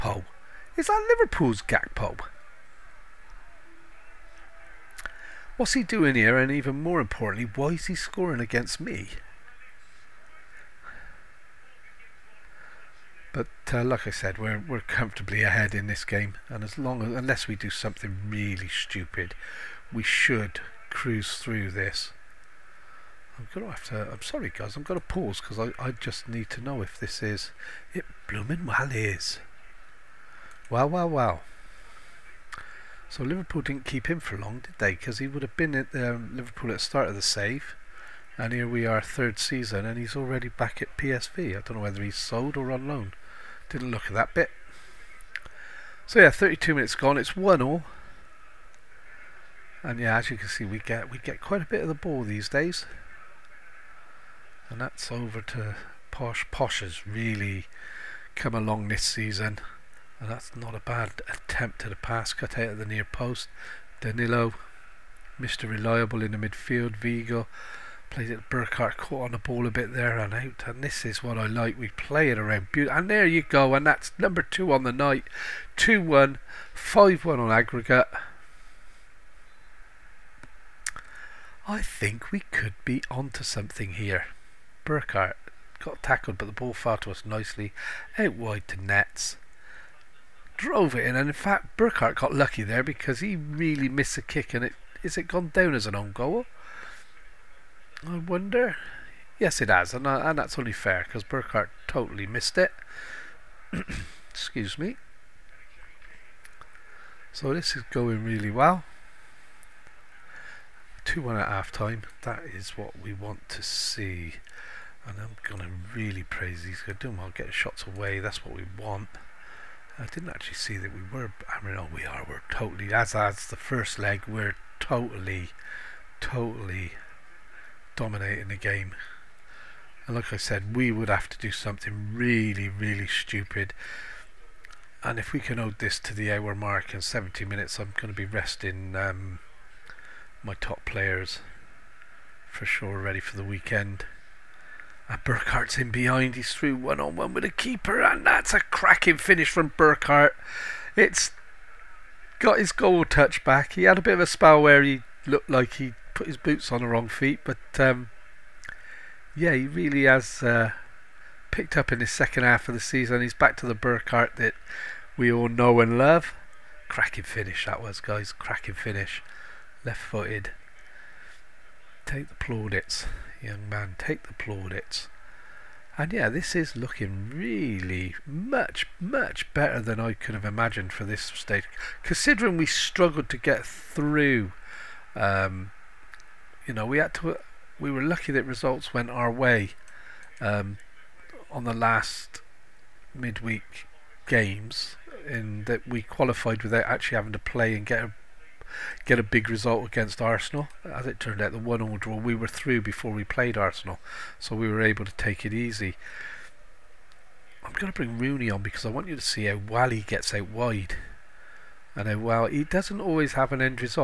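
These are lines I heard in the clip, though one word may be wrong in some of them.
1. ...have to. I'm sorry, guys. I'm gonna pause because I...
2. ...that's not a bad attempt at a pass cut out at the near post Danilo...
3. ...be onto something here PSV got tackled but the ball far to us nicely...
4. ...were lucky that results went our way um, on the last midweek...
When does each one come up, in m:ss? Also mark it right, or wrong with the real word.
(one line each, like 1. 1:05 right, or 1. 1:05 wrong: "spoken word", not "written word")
1. 0:23 right
2. 1:00 right
3. 1:22 wrong: "Burkhart", not "PSV"
4. 3:07 right.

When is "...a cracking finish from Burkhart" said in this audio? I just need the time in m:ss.
2:28.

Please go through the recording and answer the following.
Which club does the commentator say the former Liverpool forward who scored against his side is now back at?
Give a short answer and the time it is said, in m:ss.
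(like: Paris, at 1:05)
PSV, at 0:40.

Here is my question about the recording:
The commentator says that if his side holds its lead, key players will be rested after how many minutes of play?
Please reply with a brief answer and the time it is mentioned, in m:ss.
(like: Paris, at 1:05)
70, at 2:17.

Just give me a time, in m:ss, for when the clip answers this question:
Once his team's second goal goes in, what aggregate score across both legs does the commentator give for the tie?
1:16.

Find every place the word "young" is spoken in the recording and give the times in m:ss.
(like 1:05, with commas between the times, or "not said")
2:53.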